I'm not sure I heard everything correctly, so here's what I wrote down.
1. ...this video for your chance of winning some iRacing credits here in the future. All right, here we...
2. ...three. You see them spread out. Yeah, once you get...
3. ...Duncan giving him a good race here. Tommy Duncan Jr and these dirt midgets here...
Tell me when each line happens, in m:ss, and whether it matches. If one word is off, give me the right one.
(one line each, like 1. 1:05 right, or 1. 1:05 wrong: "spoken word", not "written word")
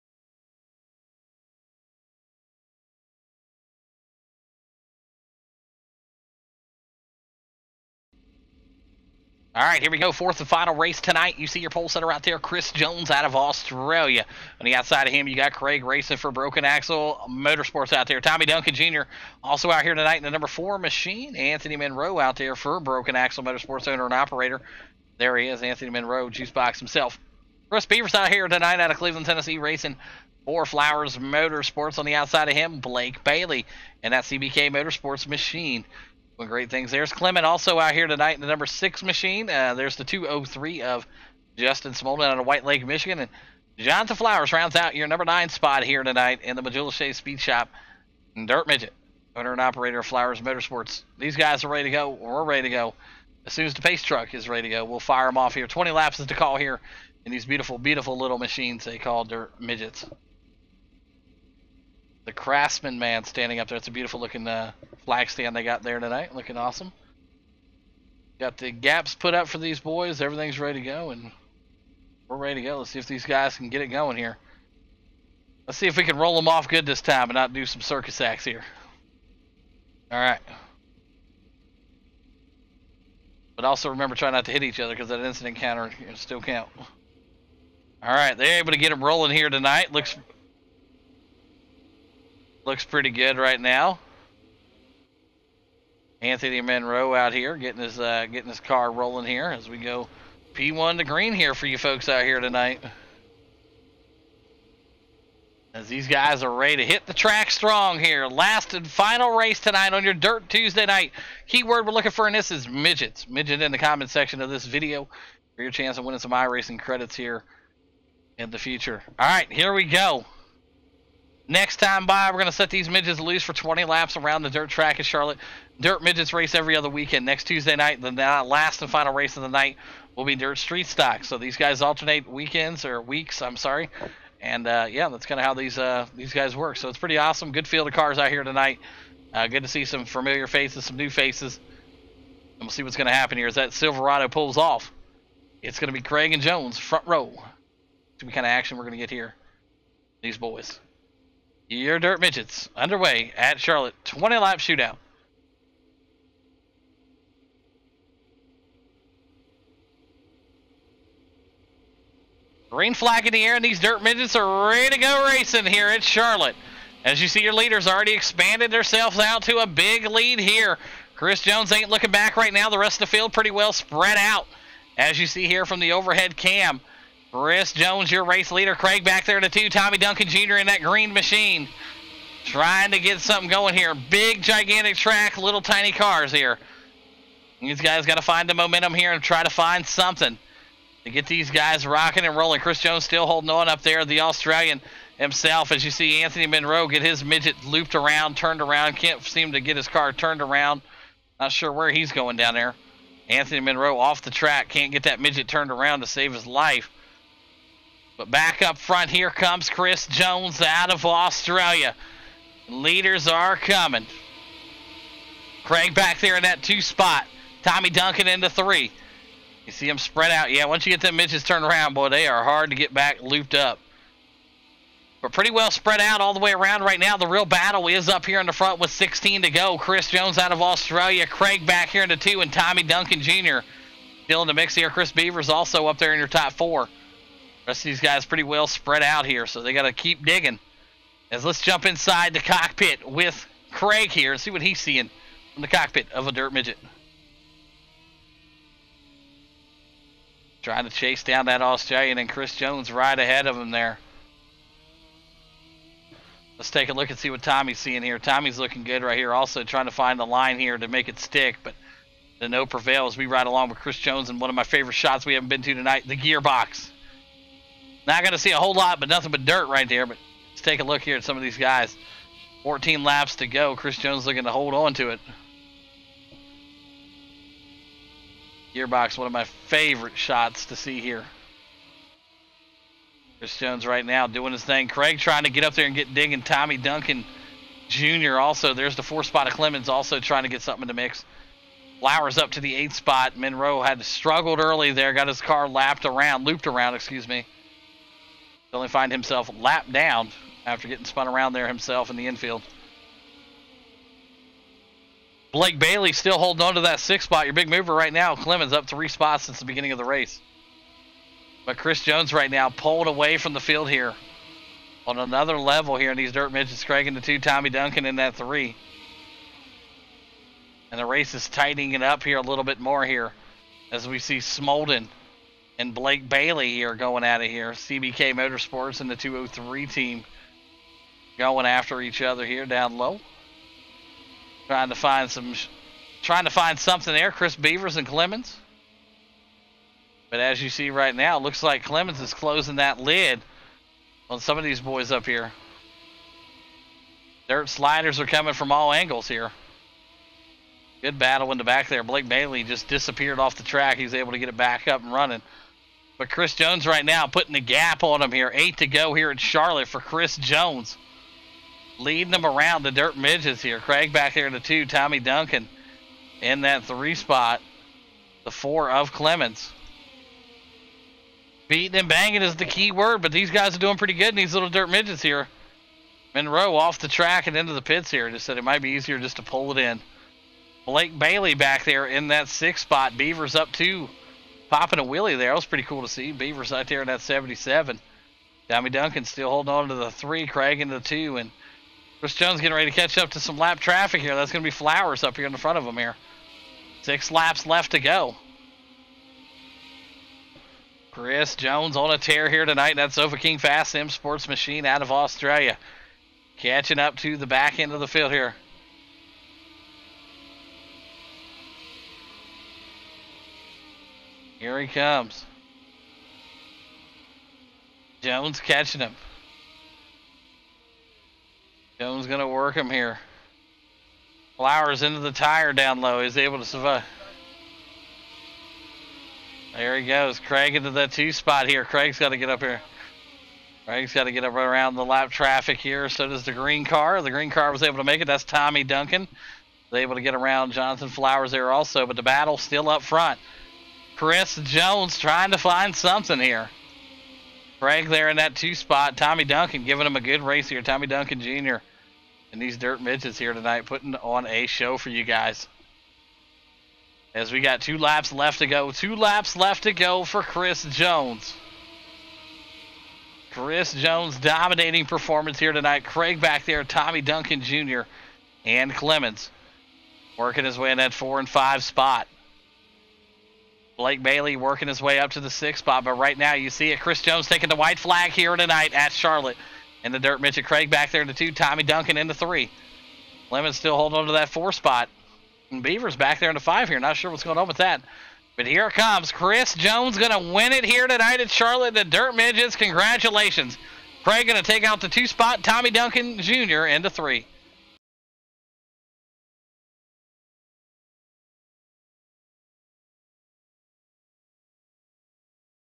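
1. 1:54 right
2. 3:38 right
3. 7:29 right.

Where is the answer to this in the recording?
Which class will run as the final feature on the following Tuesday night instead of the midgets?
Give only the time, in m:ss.
2:10.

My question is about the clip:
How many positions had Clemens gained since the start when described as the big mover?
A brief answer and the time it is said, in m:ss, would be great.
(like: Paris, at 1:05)
3, at 5:08.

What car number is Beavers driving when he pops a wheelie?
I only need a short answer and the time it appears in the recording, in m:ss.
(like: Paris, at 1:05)
77, at 6:27.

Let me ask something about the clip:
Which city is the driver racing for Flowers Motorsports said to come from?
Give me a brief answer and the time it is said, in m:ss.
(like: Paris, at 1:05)
Cleveland, Tennessee, at 0:28.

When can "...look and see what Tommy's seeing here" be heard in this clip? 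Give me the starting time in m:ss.
4:16.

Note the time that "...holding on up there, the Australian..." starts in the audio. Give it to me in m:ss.
3:13.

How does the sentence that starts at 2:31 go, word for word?
Your dirt midgets underway at Charlotte.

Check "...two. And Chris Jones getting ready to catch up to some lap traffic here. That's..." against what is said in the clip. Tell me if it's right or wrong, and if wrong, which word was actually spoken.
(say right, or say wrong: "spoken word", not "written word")
right.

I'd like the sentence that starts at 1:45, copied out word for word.
As these guys are ready to hit the track strong here.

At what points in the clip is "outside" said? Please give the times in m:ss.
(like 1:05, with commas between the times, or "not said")
0:14, 0:32.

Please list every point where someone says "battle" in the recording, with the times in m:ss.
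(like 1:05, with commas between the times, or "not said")
3:47, 5:51, 7:22.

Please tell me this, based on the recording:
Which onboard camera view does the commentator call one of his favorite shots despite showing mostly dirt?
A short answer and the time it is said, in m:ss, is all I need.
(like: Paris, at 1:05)
the gearbox, at 4:26.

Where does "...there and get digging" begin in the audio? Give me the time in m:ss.
4:45.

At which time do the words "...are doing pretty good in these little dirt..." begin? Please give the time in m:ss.
6:13.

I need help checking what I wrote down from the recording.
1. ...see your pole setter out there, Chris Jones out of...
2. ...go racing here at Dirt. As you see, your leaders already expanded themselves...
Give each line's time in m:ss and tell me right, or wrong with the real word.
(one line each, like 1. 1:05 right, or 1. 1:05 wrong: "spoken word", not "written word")
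1. 0:11 right
2. 2:44 wrong: "Charlotte", not "Dirt".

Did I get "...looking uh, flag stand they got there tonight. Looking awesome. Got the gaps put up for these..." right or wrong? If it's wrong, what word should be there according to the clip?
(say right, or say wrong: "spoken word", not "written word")
right.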